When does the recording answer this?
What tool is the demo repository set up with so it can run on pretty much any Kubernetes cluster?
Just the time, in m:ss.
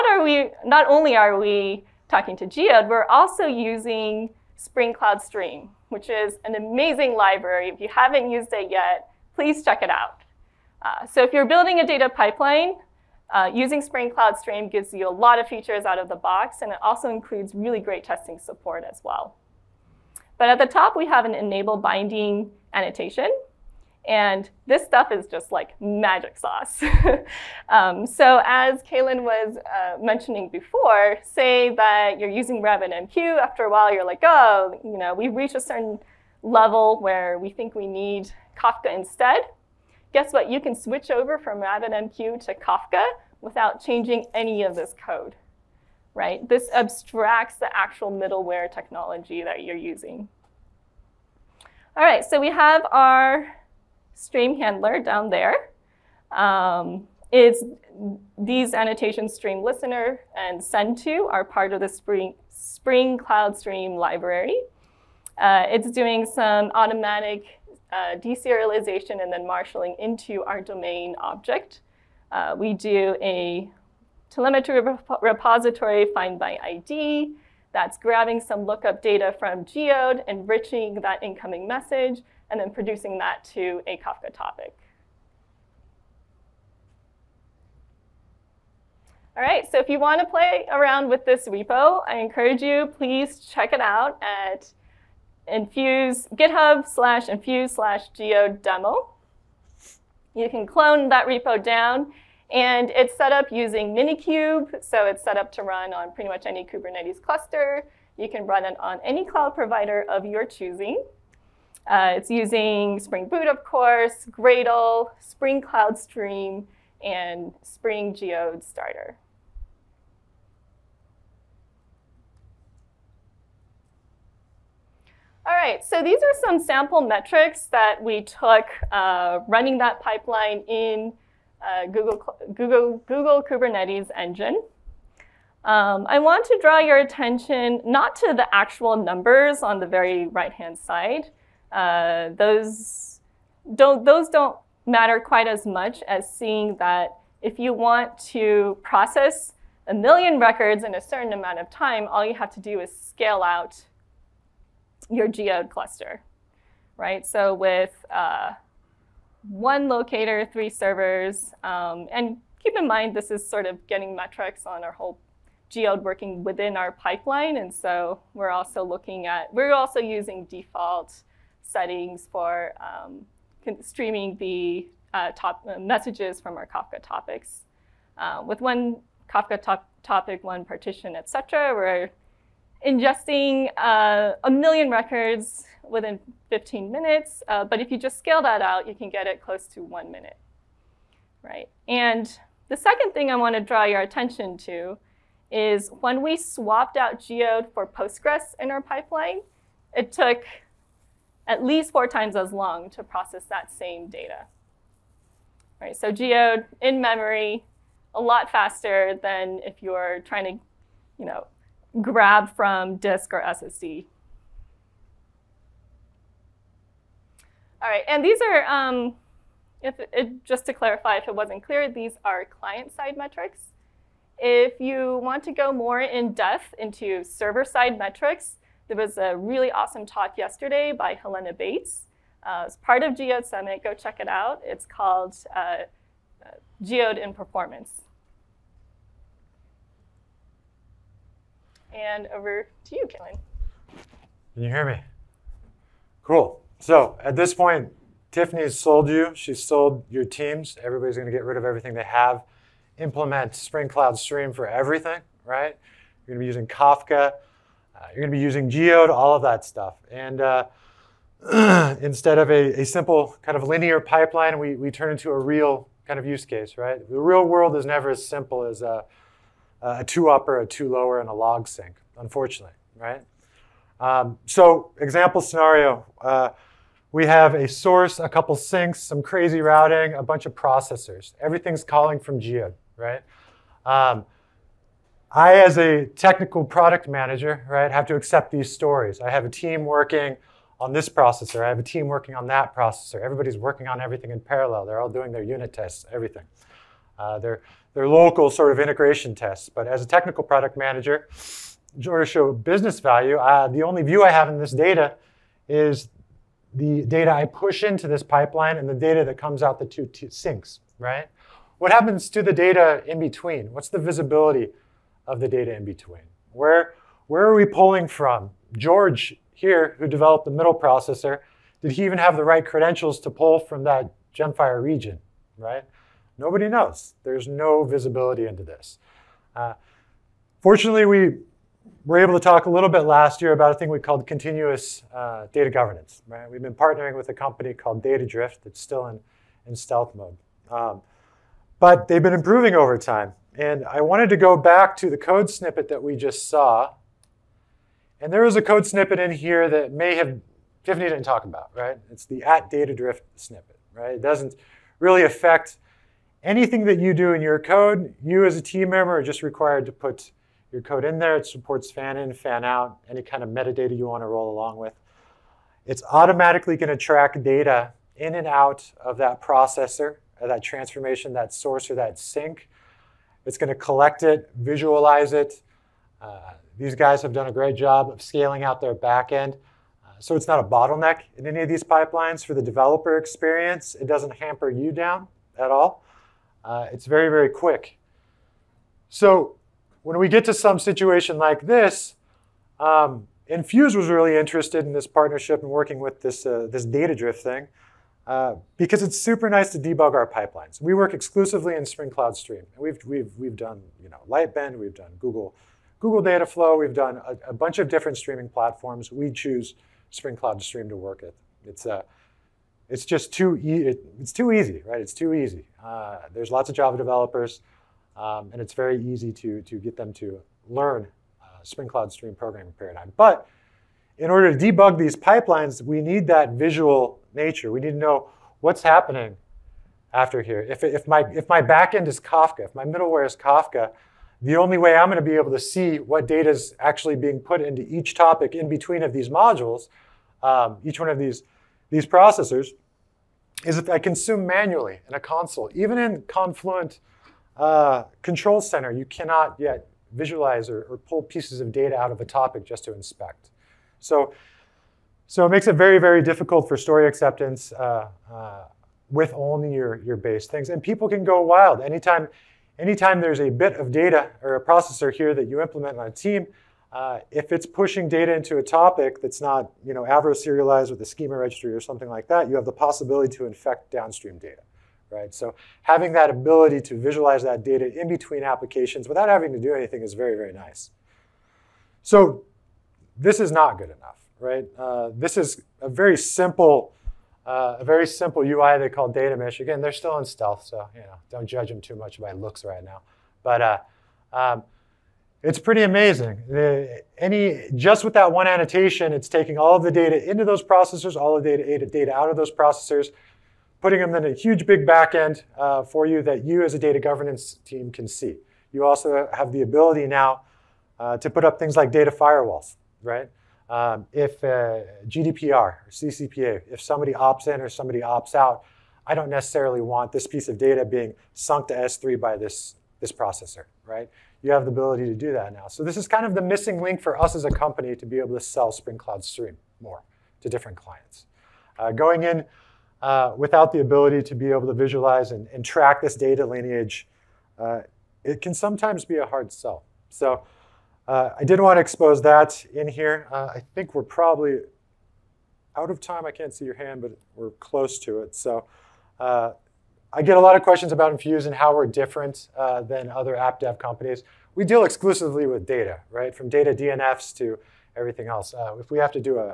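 1:43.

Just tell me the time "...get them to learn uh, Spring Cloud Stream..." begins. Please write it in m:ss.
6:59.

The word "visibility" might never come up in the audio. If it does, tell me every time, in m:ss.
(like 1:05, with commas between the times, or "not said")
5:13, 5:27.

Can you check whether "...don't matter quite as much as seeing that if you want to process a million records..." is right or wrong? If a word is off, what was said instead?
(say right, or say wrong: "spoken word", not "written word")
right.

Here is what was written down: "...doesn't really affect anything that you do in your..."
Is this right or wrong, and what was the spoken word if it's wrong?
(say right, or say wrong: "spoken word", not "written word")
right.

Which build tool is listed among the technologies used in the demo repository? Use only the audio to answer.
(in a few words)
Gradle.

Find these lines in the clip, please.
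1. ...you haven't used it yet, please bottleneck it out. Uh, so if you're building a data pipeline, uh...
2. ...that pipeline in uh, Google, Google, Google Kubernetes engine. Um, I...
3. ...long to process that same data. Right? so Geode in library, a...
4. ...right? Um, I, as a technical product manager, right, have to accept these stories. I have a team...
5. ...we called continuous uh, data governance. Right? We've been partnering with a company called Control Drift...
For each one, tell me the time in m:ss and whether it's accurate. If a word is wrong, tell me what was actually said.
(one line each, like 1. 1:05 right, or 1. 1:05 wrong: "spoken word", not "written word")
1. 0:07 wrong: "check", not "bottleneck"
2. 2:09 right
3. 3:22 wrong: "memory", not "library"
4. 4:42 right
5. 5:33 wrong: "Data", not "Control".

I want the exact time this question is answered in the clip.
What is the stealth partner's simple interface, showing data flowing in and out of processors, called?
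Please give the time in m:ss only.
8:09.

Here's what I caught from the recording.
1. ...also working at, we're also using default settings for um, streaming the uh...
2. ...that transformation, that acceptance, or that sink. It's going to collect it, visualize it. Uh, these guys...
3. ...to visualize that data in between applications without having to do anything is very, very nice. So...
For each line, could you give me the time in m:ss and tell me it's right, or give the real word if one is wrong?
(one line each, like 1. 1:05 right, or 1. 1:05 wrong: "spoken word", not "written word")
1. 2:48 wrong: "looking", not "working"
2. 6:10 wrong: "source", not "acceptance"
3. 7:56 right.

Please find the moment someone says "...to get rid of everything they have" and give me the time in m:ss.
4:11.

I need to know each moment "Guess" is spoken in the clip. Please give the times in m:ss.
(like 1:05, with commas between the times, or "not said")
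0:40.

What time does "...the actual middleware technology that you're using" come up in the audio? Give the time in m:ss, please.
0:47.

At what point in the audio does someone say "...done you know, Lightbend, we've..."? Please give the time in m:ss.
6:43.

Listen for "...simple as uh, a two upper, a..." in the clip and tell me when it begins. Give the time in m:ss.
4:28.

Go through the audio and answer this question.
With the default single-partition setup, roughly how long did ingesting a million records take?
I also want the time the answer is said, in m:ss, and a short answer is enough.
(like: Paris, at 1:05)
15 minutes, at 3:06.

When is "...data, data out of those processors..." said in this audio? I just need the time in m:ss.
8:21.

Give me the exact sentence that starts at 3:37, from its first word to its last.
All right, and these are, um, if it, just to clarify, if it wasn't clear, these are client-side metrics.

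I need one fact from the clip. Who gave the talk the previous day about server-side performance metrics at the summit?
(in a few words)
Helena Bates.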